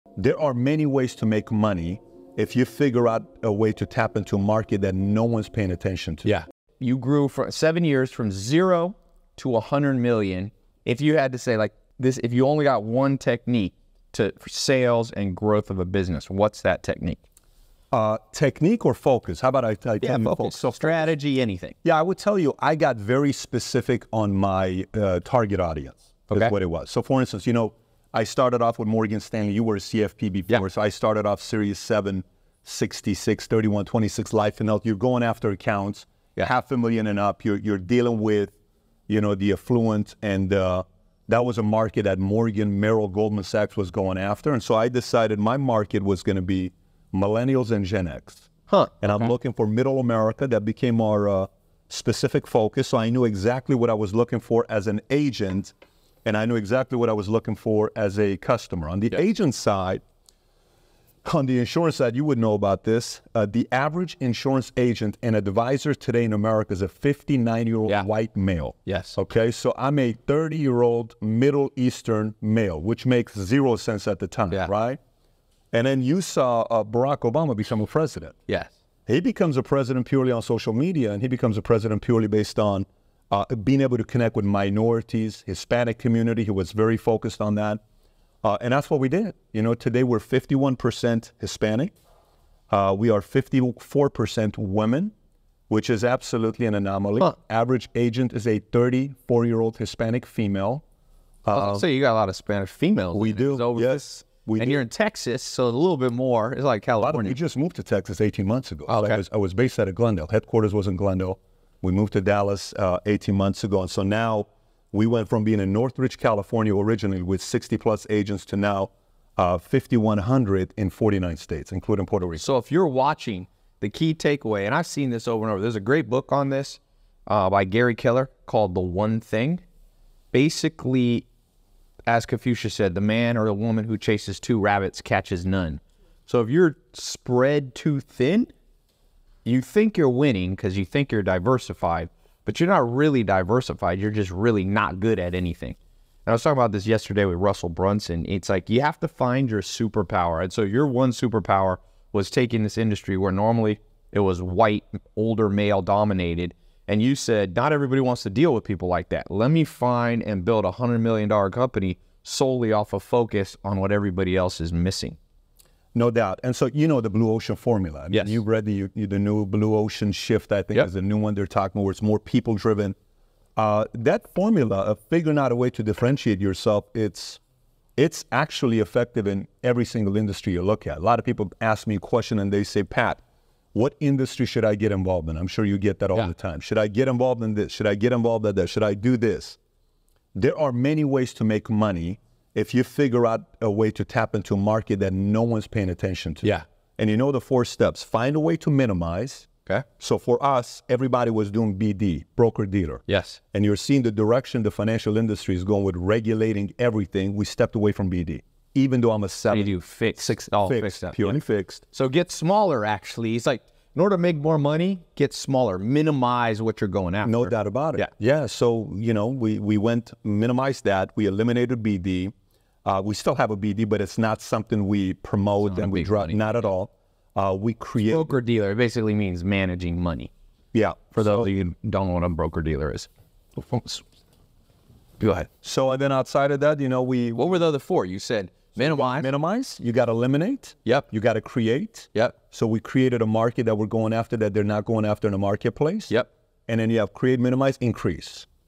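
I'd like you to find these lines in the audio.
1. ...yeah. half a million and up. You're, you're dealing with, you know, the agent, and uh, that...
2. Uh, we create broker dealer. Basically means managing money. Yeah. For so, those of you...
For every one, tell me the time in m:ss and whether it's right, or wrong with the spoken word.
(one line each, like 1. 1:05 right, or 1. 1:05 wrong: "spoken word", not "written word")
1. 0:36 wrong: "affluent", not "agent"
2. 3:47 right.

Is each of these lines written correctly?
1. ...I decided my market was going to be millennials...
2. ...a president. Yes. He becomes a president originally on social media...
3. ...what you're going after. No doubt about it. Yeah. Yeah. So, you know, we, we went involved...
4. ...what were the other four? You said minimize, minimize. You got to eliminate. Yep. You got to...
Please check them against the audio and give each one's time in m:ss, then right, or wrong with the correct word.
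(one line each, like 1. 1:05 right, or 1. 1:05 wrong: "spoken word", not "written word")
1. 0:44 right
2. 1:17 wrong: "purely", not "originally"
3. 3:36 wrong: "minimized", not "involved"
4. 3:57 right.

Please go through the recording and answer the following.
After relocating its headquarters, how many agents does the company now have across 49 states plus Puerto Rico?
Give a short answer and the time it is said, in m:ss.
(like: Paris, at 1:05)
5,100, at 1:59.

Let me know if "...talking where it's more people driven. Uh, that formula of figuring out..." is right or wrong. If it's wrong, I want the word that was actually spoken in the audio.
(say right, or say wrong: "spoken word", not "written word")
right.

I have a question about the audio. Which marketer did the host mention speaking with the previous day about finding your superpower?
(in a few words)
Russell Brunson.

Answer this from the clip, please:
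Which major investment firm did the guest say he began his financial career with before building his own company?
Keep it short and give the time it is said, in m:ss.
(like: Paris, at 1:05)
Morgan Stanley, at 0:28.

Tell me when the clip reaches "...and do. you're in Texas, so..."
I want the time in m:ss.
1:44.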